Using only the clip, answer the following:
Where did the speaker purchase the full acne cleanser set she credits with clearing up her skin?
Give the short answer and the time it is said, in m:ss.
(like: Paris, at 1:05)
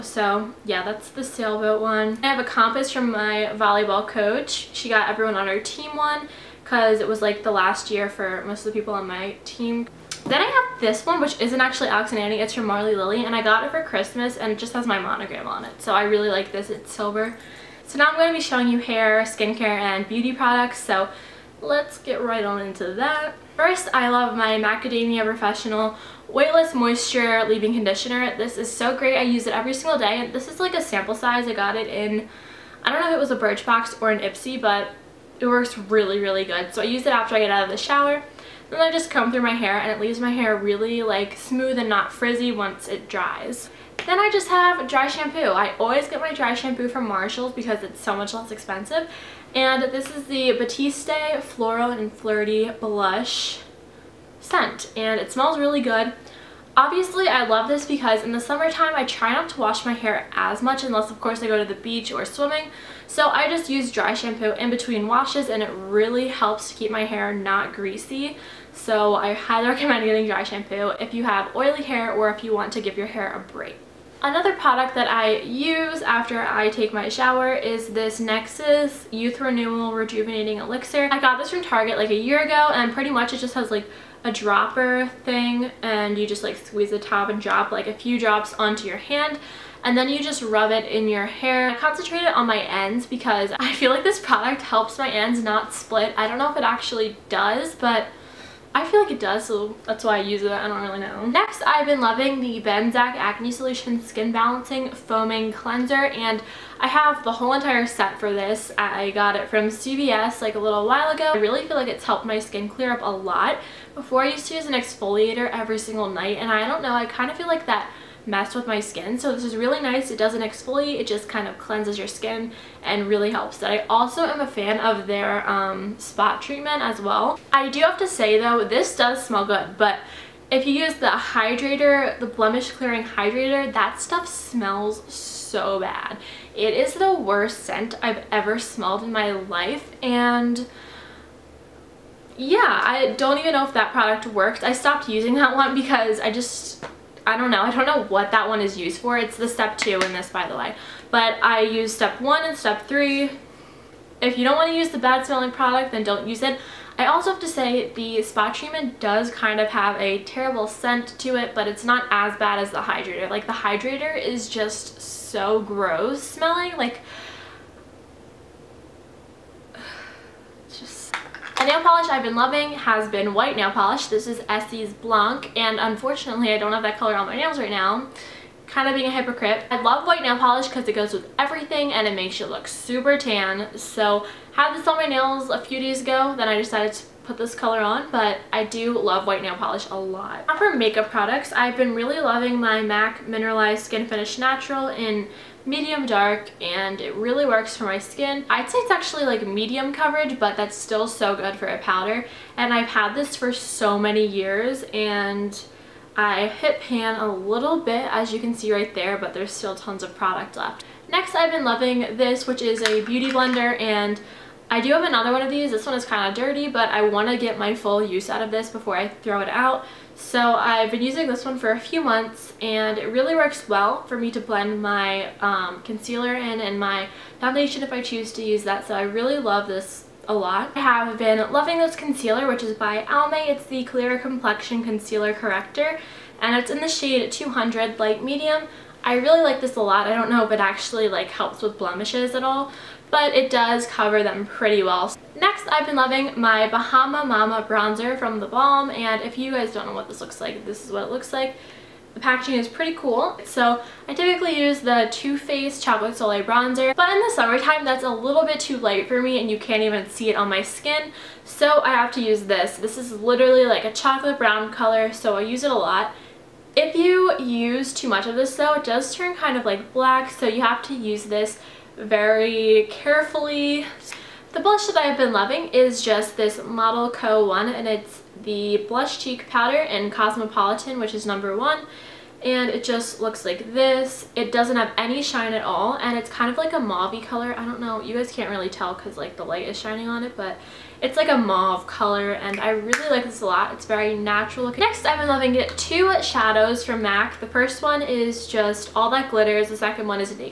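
CVS, at 1:49.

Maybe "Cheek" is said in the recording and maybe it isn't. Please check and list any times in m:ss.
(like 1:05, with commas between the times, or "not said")
4:39.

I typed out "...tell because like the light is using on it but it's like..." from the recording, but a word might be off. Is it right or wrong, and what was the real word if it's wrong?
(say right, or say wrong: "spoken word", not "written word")
wrong: "shining", not "using".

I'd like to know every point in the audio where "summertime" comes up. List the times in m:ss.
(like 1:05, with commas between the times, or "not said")
0:58, 4:17.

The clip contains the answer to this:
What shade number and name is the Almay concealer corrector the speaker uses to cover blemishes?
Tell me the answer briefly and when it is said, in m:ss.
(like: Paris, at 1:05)
200 Light Medium, at 3:57.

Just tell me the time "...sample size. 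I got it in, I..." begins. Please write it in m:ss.
0:30.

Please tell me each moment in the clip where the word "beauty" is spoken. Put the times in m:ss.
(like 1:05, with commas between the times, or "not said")
0:20, 3:33.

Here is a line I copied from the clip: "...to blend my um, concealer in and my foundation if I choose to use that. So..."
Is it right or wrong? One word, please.
right.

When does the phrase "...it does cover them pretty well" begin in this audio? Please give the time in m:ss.
4:03.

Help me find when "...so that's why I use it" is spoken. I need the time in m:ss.
1:39.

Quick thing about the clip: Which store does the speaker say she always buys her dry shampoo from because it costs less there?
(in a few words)
Marshalls.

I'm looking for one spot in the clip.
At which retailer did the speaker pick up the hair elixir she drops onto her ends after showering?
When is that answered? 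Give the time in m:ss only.
1:21.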